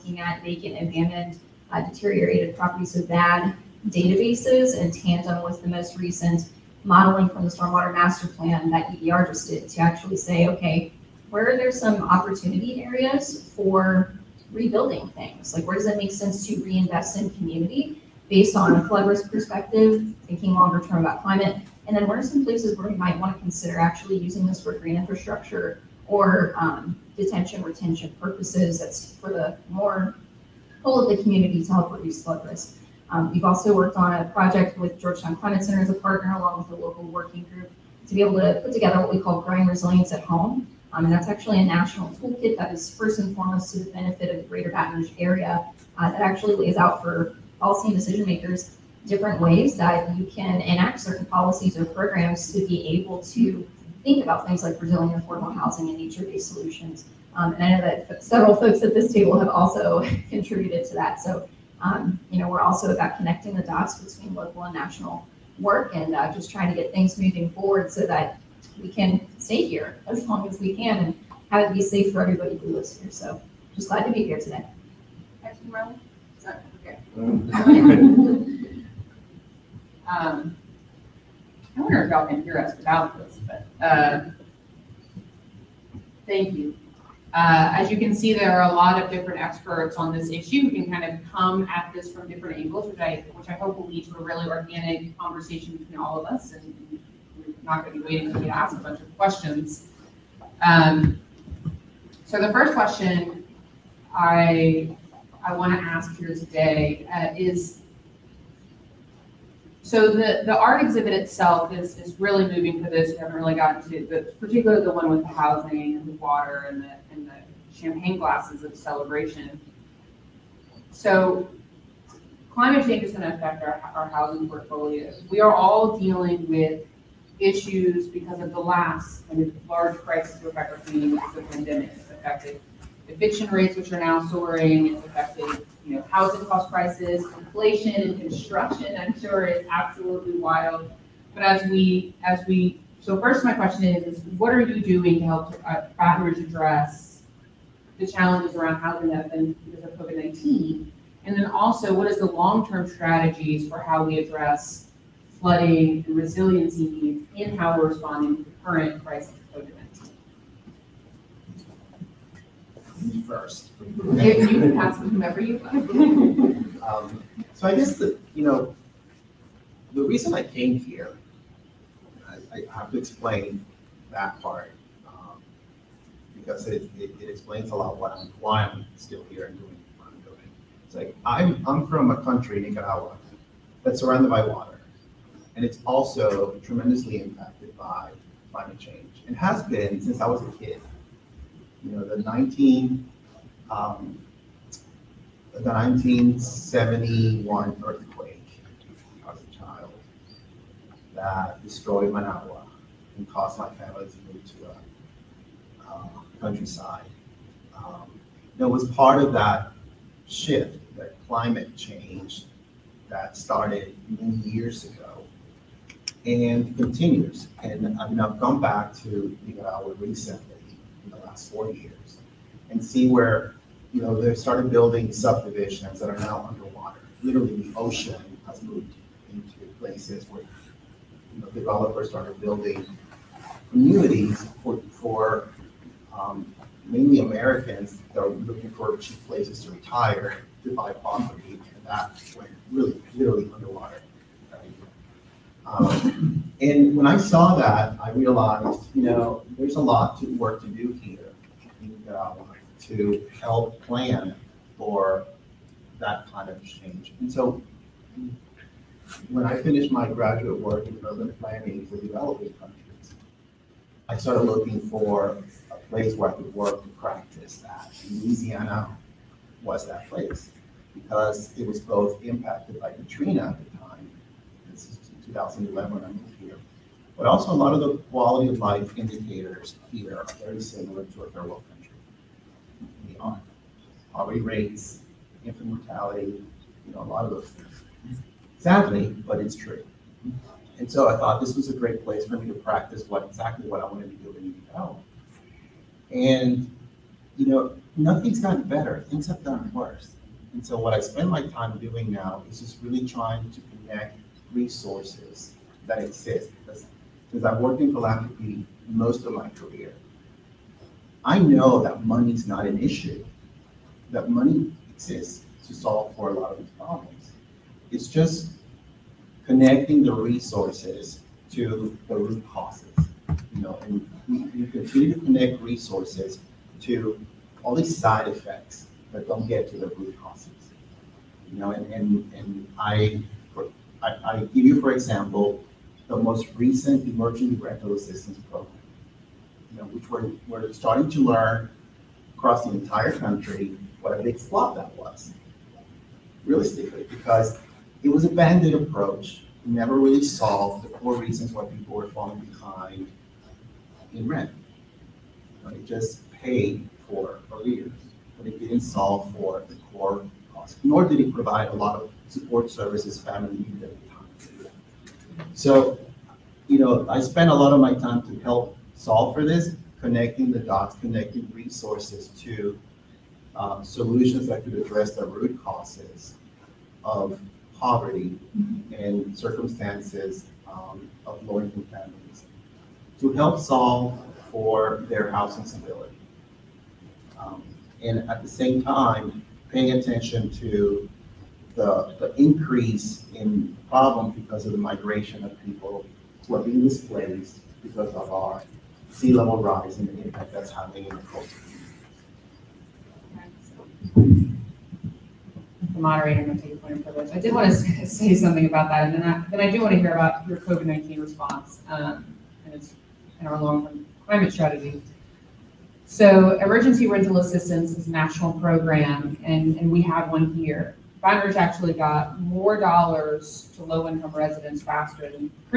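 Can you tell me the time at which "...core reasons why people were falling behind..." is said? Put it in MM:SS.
05:50.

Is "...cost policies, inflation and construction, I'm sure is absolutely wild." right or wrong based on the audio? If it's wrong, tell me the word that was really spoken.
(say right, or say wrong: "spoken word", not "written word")
wrong: "prices", not "policies".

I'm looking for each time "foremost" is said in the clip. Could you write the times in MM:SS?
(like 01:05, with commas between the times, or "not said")
00:43.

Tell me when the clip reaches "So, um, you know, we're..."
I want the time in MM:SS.
01:01.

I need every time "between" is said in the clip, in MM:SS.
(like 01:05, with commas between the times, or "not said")
01:03, 01:35.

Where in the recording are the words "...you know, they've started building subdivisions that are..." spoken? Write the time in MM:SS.
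03:43.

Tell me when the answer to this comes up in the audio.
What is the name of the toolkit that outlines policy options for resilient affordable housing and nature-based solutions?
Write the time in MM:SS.
00:39.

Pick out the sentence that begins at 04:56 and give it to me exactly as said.
And you know, nothing's gotten better.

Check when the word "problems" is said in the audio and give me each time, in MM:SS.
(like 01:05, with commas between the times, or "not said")
05:16, 06:33.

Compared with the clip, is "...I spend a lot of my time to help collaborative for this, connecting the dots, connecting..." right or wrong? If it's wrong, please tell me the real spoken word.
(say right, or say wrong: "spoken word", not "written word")
wrong: "solve", not "collaborative".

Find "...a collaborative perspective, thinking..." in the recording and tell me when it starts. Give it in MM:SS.
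00:18.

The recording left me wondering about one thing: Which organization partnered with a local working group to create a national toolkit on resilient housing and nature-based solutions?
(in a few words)
Georgetown Climate Center.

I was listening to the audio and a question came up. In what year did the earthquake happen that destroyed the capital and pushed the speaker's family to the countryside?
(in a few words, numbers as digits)
1971.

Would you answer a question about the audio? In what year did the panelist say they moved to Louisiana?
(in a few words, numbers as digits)
2011.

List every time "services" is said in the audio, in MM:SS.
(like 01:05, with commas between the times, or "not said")
06:02.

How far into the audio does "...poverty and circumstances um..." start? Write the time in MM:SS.
06:17.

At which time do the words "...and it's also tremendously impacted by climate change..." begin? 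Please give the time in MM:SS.
03:05.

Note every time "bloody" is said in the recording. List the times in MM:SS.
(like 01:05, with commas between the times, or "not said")
not said.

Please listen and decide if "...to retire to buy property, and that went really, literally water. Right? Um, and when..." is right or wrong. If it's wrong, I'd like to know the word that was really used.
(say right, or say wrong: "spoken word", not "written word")
wrong: "underwater", not "water".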